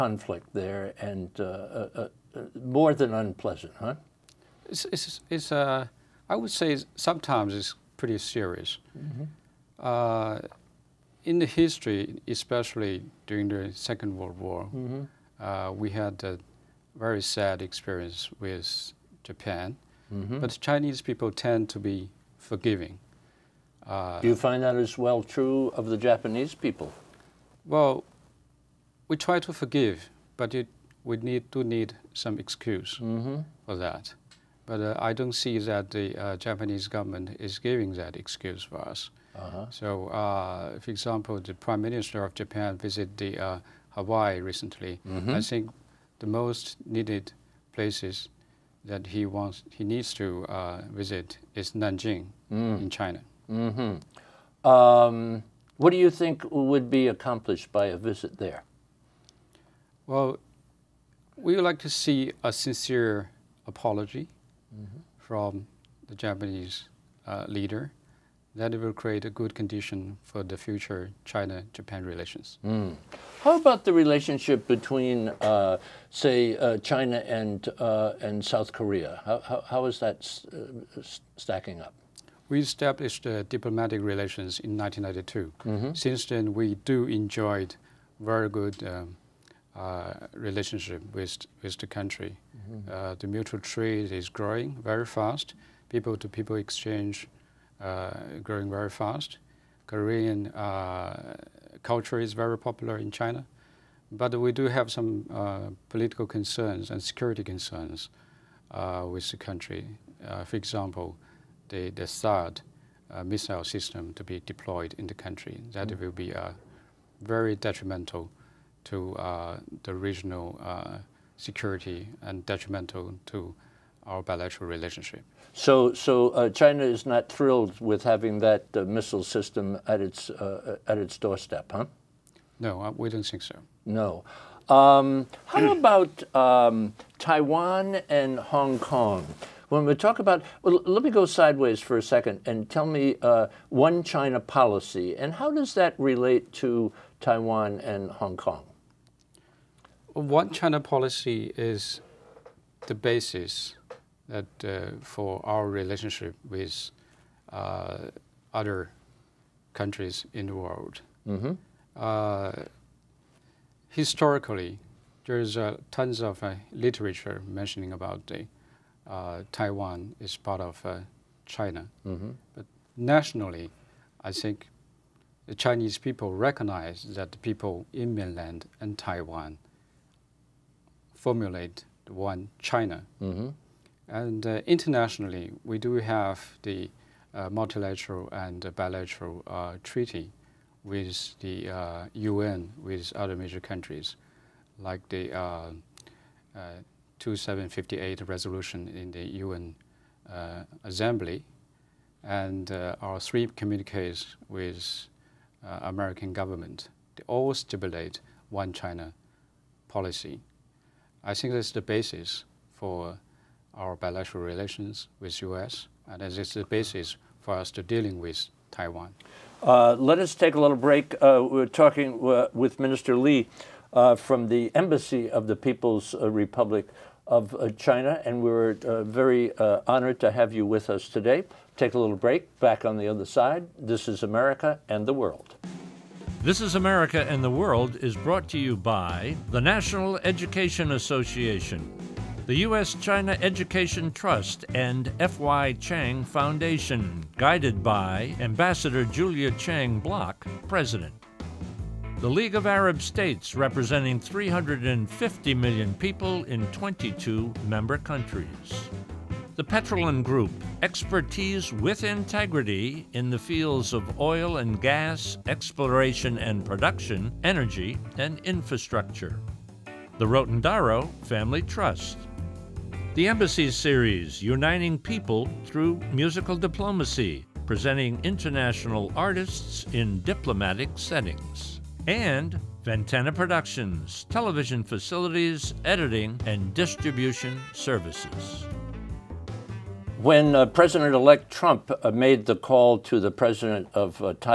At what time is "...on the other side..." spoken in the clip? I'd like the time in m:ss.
3:52.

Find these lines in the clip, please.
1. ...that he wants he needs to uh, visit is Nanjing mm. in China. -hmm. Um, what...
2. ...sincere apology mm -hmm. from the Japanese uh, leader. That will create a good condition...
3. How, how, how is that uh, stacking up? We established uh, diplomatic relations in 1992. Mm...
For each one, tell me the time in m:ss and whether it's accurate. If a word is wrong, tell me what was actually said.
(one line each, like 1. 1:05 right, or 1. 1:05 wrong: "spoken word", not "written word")
1. 0:48 right
2. 1:02 right
3. 1:19 right.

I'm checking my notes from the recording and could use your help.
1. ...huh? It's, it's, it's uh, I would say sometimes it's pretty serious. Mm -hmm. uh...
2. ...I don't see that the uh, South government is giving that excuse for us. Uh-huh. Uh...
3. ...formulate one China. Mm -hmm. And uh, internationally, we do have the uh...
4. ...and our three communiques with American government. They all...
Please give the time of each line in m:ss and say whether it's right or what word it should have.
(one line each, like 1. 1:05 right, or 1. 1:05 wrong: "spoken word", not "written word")
1. 0:03 right
2. 0:35 wrong: "Japanese", not "South"
3. 3:01 right
4. 3:22 right.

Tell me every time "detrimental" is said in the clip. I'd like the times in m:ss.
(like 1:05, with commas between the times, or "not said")
1:57, 2:02.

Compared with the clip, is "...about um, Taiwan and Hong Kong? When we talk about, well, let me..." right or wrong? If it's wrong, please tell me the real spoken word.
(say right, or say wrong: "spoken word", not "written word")
right.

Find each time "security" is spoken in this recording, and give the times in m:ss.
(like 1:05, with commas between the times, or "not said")
1:47, 2:01.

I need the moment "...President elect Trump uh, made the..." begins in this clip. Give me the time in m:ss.
4:50.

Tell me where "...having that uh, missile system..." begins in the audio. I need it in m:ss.
2:08.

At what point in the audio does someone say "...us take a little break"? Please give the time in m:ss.
3:40.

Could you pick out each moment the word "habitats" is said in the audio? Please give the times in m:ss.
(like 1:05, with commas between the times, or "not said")
not said.